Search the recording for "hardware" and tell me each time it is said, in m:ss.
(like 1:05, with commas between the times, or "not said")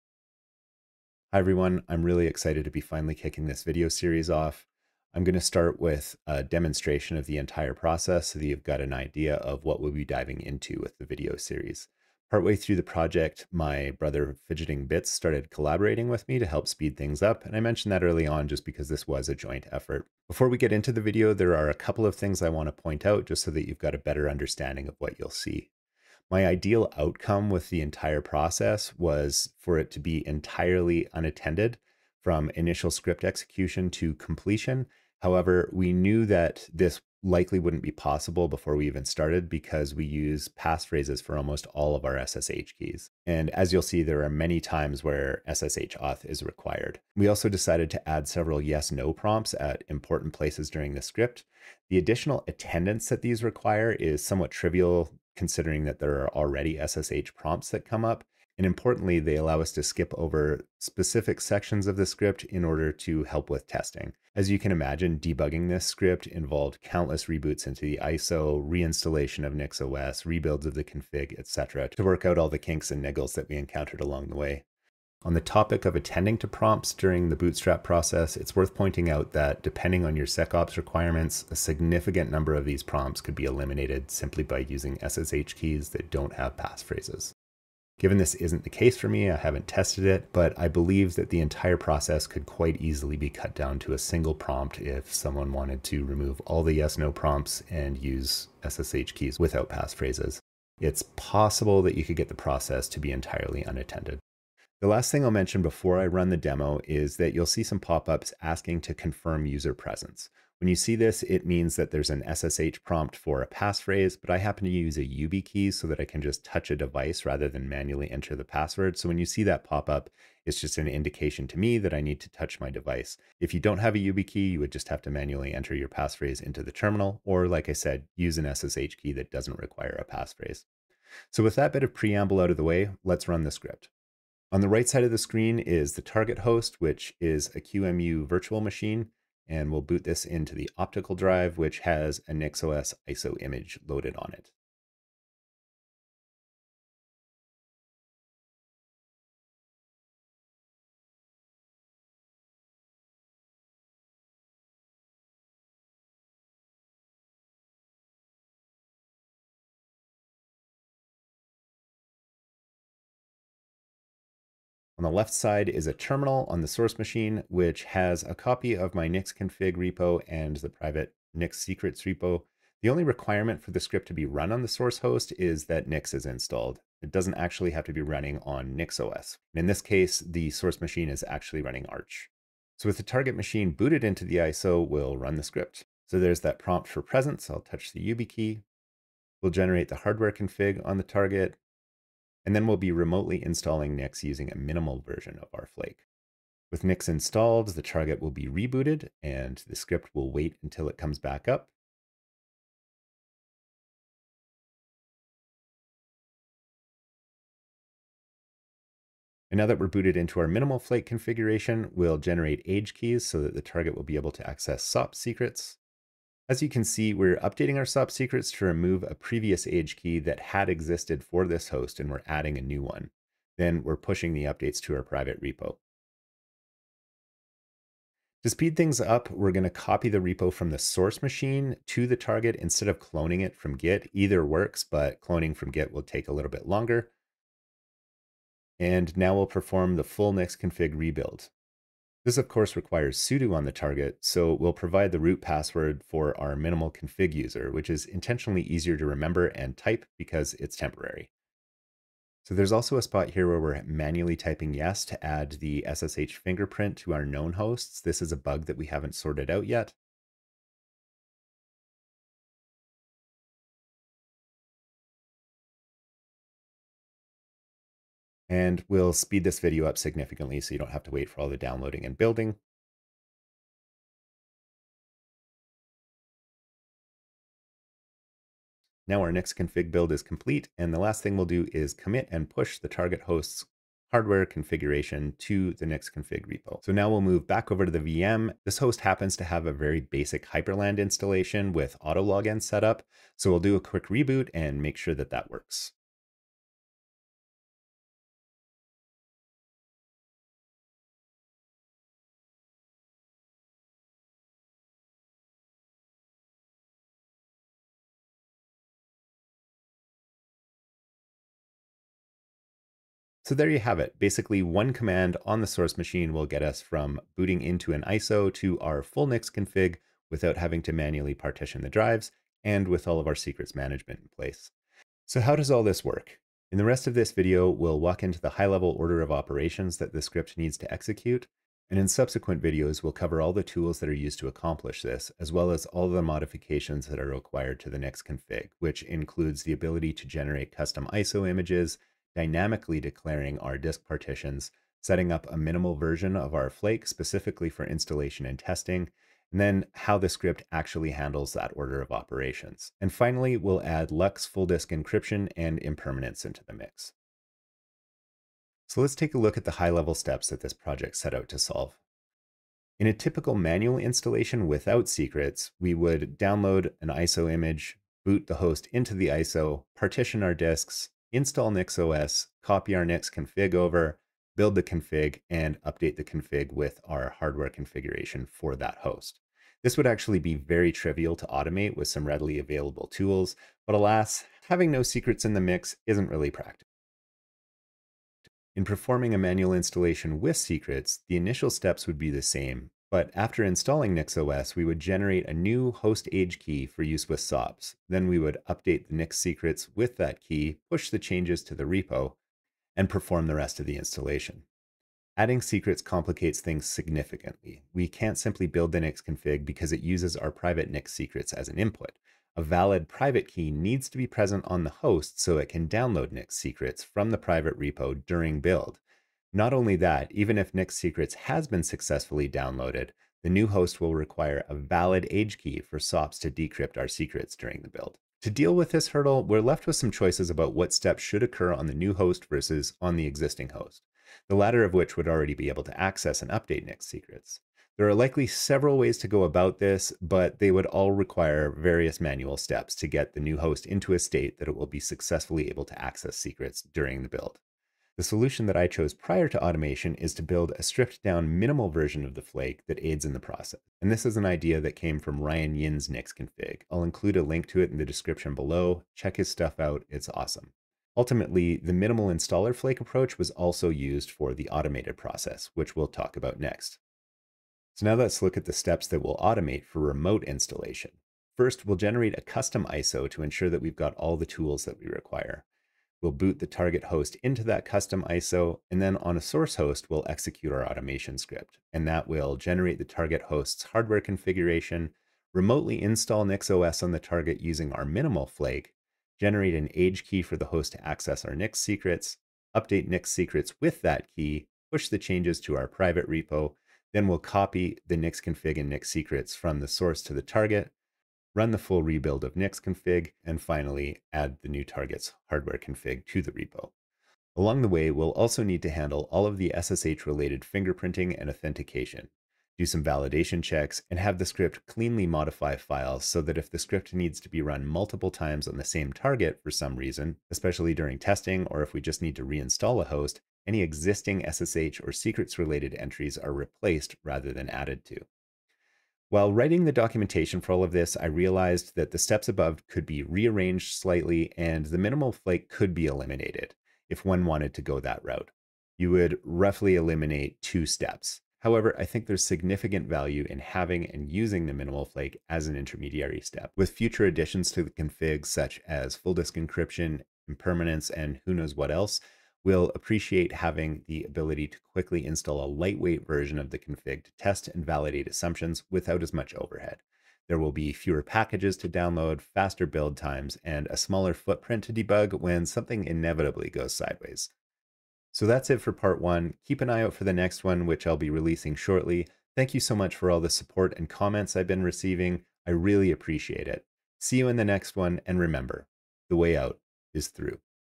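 3:09, 4:44, 6:17, 8:03, 8:25.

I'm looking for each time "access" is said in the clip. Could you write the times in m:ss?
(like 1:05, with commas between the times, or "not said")
3:34, 7:15, 7:26, 8:11.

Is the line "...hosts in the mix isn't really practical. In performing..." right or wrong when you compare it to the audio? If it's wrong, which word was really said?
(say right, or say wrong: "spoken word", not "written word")
wrong: "secrets", not "hosts".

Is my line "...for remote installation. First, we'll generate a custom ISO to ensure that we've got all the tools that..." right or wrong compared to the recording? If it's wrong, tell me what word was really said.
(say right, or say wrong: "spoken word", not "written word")
right.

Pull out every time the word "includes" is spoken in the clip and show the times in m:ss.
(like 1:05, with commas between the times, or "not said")
5:39, 7:37.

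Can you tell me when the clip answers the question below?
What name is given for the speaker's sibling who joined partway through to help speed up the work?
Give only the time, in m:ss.
0:14.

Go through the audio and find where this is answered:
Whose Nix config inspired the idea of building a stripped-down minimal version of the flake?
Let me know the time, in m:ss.
7:35.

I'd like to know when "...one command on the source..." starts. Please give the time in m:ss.
5:14.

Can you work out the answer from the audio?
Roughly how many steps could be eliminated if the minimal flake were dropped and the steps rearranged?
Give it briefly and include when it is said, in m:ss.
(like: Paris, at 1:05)
2, at 9:00.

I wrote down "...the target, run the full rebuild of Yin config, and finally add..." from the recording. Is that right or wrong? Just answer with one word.
wrong.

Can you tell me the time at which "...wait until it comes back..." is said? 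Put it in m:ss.
3:20.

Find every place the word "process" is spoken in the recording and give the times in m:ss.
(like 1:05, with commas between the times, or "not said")
0:07, 0:28, 1:17, 1:31, 1:42, 7:33, 7:45.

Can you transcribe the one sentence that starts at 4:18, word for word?
This is a bug that we haven't sorted out yet.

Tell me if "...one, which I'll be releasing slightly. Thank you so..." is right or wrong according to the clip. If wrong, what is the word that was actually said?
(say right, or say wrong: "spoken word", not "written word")
wrong: "shortly", not "slightly".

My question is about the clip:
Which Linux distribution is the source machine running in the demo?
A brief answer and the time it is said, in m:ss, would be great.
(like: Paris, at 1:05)
Arch, at 3:01.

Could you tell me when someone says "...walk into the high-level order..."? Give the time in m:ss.
5:27.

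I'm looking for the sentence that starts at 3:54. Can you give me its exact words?
Either works, but cloning from Git will take a little bit longer.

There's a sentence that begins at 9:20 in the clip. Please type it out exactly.
There will be fewer packages to download, faster build times, and a smaller footprint to debug when something inevitably goes sideways.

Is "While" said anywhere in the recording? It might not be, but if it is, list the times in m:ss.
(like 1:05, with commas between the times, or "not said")
8:49.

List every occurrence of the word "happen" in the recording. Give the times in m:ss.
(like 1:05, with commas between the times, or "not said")
1:54, 4:48.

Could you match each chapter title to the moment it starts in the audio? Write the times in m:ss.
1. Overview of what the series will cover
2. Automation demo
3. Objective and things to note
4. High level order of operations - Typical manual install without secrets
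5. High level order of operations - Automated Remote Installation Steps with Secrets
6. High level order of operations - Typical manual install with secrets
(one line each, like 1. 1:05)
1. 5:13
2. 2:10
3. 0:24
4. 6:00
5. 7:48
6. 6:27.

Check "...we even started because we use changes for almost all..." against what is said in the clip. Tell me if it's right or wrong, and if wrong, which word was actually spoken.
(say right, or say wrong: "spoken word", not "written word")
wrong: "passphrases", not "changes".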